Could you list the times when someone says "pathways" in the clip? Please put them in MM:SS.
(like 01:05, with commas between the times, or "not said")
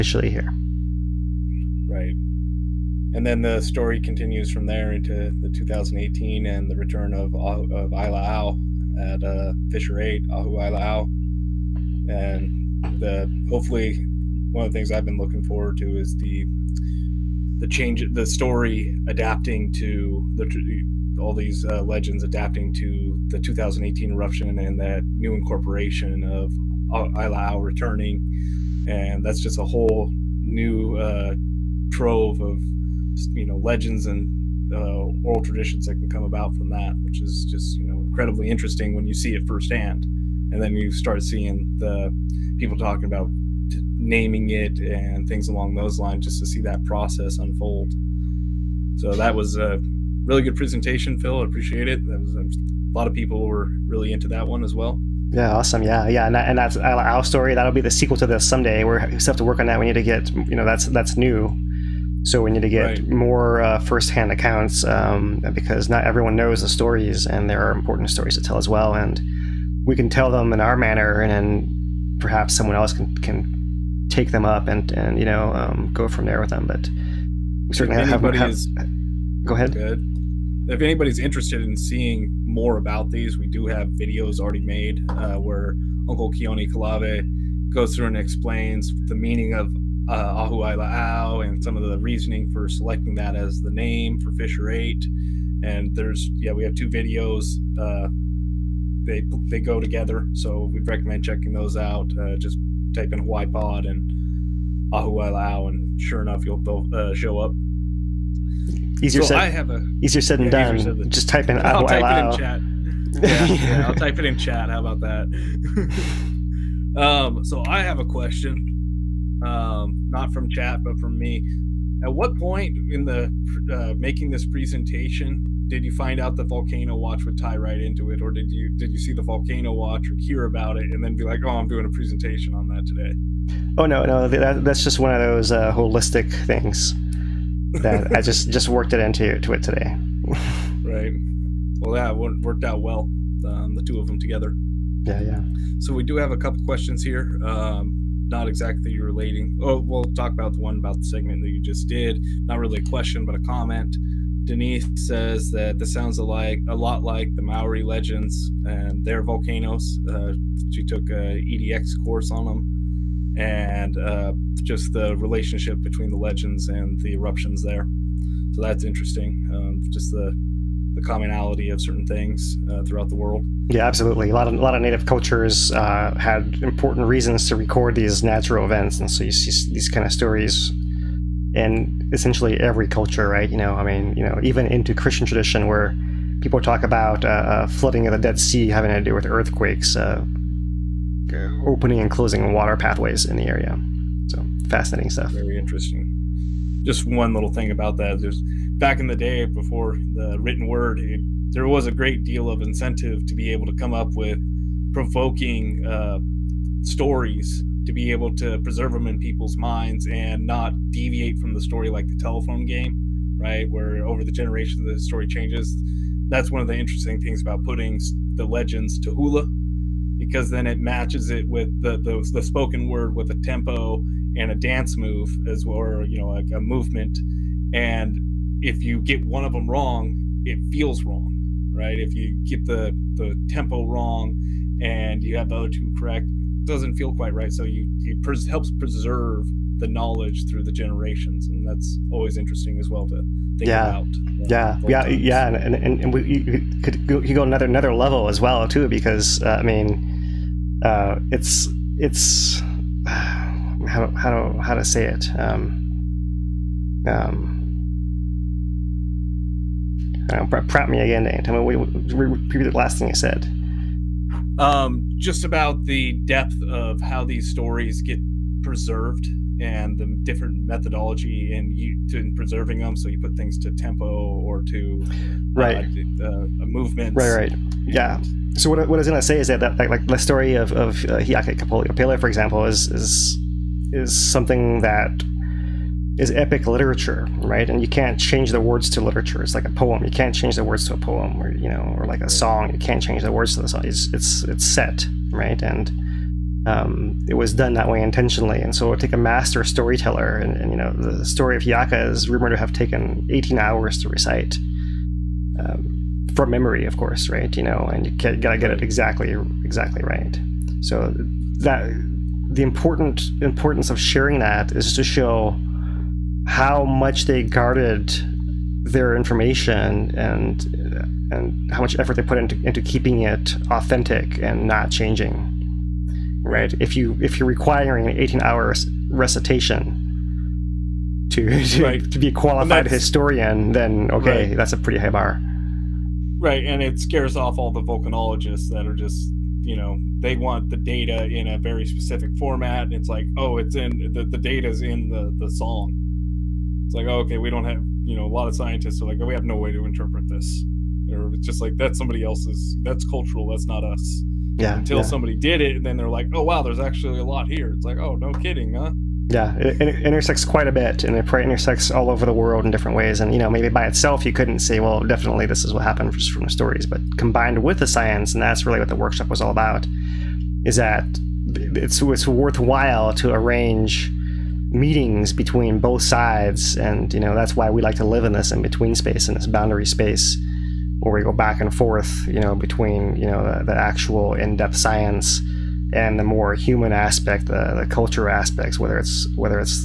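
03:12.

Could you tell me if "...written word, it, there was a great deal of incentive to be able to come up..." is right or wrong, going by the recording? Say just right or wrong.
right.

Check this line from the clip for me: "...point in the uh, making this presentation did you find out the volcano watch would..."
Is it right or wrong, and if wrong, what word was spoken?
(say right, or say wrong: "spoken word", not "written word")
right.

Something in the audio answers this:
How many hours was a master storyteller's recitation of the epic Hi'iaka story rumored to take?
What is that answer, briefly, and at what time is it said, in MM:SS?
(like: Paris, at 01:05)
18, at 05:03.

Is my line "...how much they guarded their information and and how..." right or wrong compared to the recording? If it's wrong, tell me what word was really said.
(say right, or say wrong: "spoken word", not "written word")
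right.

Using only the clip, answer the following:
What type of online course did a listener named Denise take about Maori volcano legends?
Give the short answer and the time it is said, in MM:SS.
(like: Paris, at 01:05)
EDX course, at 02:41.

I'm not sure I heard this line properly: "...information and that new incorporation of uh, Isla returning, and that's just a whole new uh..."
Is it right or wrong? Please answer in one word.
wrong.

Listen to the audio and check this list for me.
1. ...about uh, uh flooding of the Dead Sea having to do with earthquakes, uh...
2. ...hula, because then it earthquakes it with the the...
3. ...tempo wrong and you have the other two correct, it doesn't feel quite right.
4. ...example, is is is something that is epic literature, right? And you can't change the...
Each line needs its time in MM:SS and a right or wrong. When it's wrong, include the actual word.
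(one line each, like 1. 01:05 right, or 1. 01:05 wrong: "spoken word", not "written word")
1. 03:06 right
2. 03:39 wrong: "matches", not "earthquakes"
3. 03:53 right
4. 04:42 right.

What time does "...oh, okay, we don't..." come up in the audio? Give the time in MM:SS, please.
05:47.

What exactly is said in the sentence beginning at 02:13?
Oh no, no, that, that's just one of those uh, holistic things that I just just worked it into to it today.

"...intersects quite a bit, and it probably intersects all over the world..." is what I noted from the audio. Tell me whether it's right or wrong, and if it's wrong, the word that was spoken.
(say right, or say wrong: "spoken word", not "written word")
right.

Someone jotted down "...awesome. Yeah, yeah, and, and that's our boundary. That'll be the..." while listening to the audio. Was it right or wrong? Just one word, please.
wrong.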